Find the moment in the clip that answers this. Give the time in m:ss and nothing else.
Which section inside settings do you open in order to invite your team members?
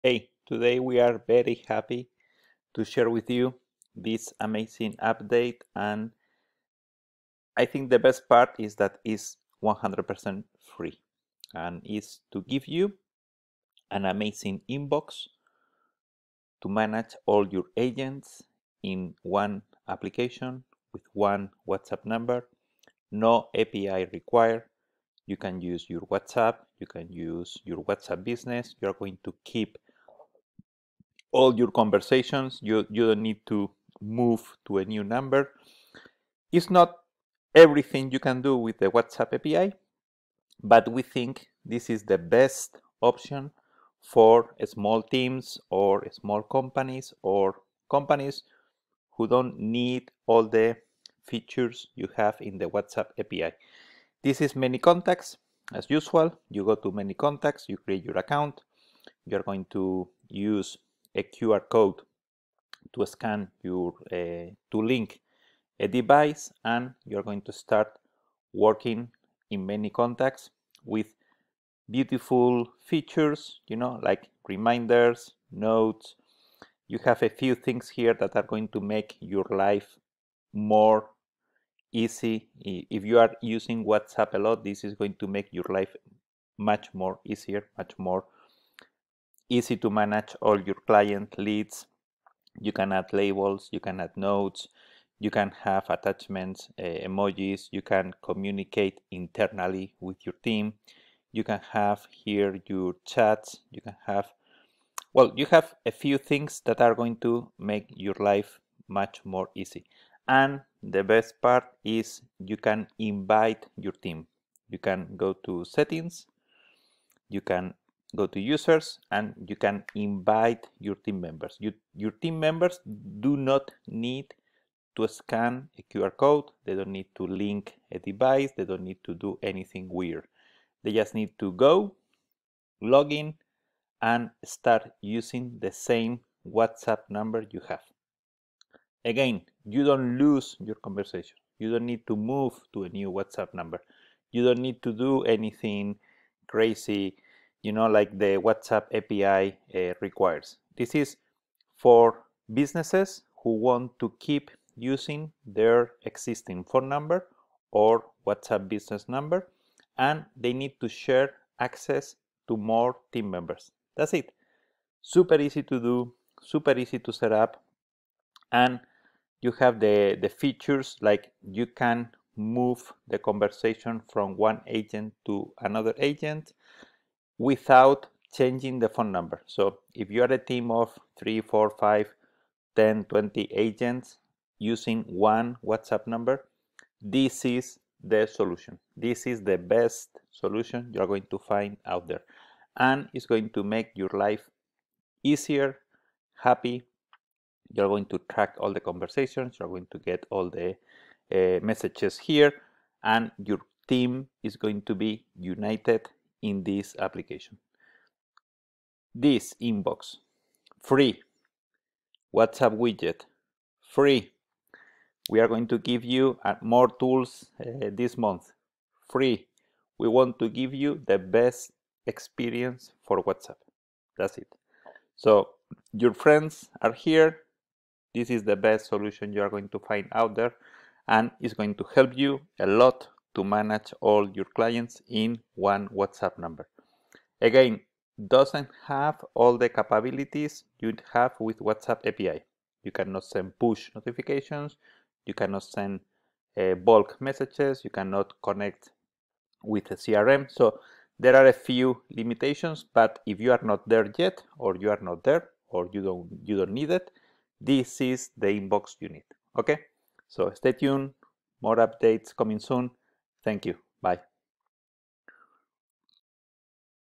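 1:57.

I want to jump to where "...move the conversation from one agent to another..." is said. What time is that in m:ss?
2:52.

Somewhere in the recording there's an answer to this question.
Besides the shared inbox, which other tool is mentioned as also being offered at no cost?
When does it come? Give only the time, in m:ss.
3:32.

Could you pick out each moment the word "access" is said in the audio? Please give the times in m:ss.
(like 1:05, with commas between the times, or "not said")
2:41.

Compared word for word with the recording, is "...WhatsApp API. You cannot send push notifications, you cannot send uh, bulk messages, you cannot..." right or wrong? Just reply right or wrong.
right.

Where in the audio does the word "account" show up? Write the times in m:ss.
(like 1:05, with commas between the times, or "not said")
0:58.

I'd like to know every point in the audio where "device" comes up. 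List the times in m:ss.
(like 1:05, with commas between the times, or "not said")
1:05, 2:07.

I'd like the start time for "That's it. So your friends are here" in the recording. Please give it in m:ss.
3:44.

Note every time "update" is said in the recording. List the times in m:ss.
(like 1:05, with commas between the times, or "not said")
0:04, 4:21.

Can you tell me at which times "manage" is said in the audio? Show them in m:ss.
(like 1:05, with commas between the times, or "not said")
0:16, 1:29, 3:53.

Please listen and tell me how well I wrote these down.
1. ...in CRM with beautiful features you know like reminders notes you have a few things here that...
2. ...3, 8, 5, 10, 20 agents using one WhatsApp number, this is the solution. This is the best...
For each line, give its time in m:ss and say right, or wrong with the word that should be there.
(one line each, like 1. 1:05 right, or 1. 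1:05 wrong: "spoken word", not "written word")
1. 1:09 wrong: "ManyContacts", not "CRM"
2. 3:01 wrong: "4", not "8".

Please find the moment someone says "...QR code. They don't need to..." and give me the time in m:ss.
2:05.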